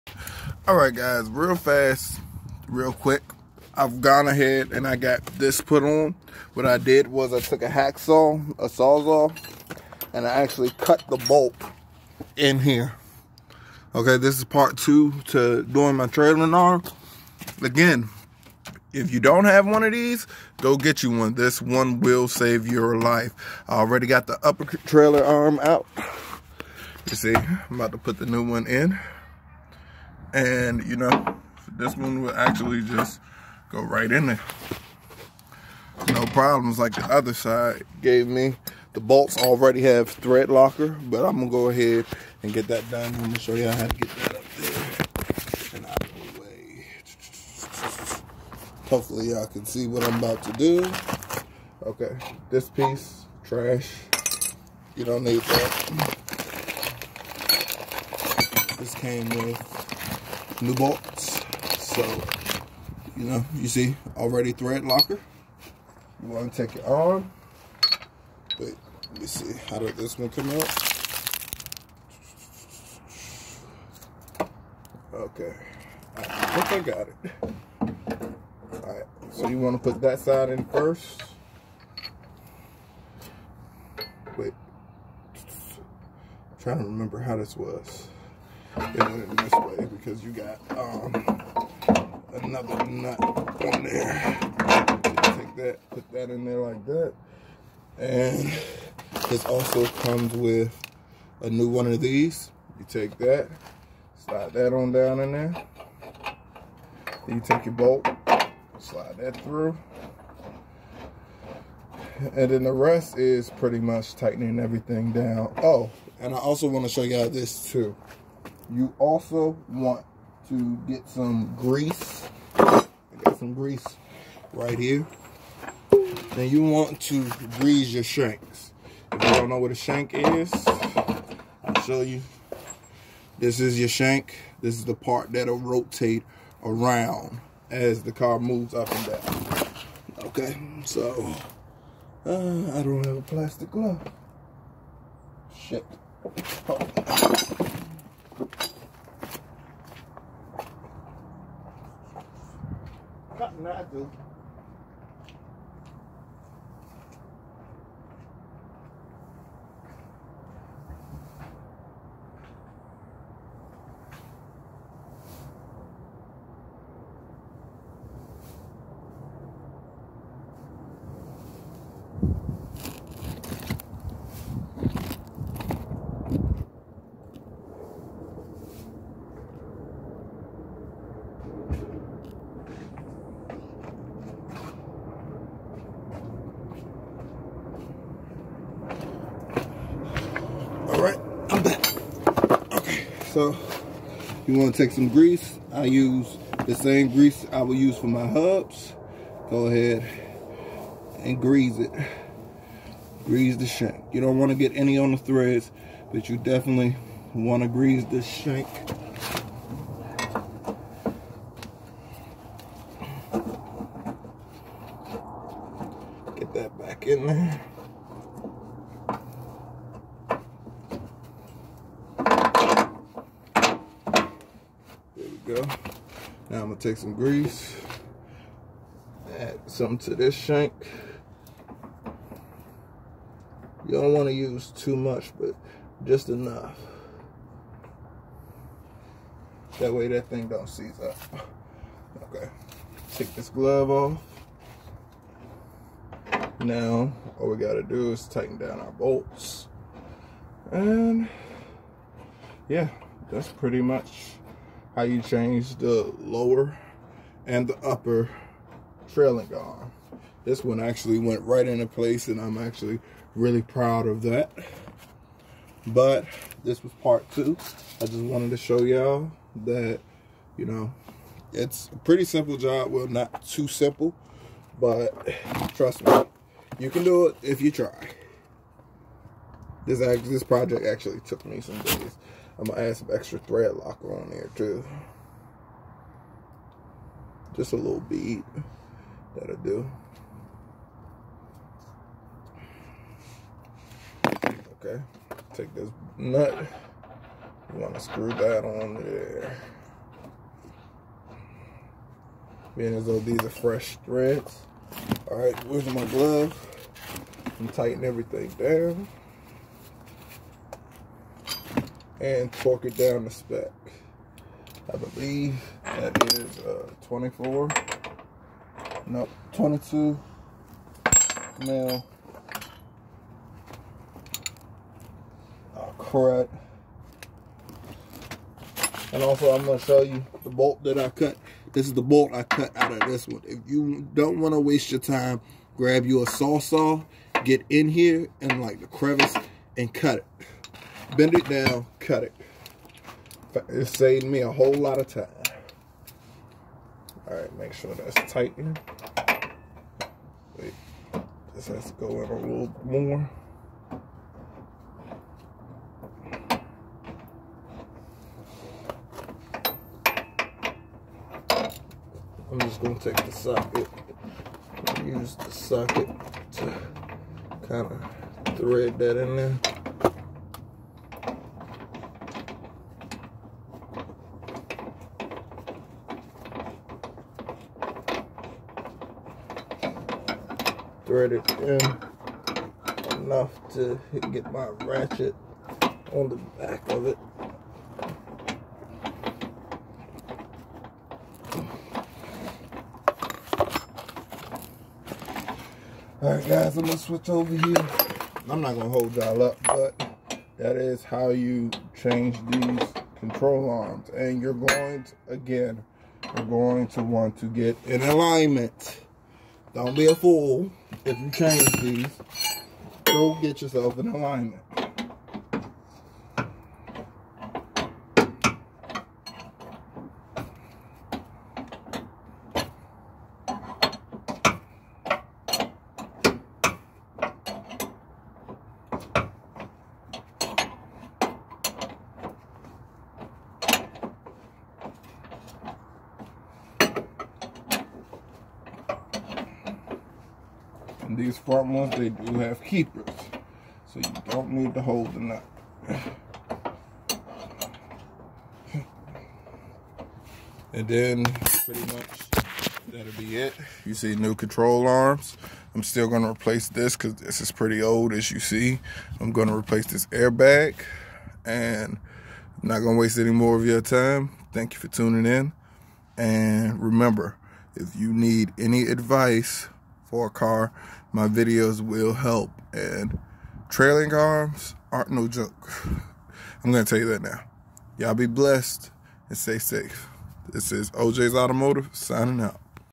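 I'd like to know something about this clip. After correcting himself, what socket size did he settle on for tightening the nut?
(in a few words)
22 mm.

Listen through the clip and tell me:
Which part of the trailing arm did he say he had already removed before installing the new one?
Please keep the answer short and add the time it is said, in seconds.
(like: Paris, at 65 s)
Upper trailing arm, at 24 s.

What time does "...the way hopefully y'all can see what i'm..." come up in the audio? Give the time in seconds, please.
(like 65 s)
46 s.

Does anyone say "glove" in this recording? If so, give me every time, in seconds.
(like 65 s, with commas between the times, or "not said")
143 s, 243 s, 306 s.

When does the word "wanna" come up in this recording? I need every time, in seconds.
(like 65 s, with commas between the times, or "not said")
234 s, 297 s, 334 s.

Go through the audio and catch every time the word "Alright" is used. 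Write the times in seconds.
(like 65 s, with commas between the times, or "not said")
78 s, 305 s, 396 s.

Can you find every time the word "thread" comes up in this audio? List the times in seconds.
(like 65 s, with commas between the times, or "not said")
40 s, 64 s, 205 s, 283 s, 304 s, 368 s, 381 s.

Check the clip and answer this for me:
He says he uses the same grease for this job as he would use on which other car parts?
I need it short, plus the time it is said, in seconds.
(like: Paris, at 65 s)
Hubs, at 198 s.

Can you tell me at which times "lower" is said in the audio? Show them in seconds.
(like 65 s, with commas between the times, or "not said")
256 s.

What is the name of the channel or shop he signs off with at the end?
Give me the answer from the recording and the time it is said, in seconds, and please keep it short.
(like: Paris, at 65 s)
OJ's Automotive, at 480 s.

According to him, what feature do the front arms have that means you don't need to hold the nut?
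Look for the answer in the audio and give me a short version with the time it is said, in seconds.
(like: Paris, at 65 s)
Keepers, at 442 s.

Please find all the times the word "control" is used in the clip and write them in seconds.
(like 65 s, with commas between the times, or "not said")
403 s, 454 s.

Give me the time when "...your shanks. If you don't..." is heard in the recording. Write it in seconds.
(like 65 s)
127 s.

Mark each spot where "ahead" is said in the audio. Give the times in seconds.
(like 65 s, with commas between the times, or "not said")
4 s, 41 s, 199 s.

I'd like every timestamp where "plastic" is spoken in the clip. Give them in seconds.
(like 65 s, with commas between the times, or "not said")
143 s.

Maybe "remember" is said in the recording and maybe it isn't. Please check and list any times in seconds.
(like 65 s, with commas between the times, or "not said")
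86 s, 466 s.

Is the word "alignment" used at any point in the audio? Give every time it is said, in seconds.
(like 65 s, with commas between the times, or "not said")
408 s, 414 s.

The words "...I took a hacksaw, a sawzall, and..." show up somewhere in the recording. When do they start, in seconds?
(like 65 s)
7 s.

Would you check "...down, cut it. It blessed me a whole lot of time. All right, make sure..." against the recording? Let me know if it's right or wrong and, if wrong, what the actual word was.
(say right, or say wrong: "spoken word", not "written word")
wrong: "saved", not "blessed".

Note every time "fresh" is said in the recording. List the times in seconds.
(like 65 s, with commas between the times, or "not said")
303 s.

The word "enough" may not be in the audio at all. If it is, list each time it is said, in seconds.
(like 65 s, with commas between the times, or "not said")
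236 s, 383 s.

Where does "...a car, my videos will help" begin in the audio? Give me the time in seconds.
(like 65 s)
470 s.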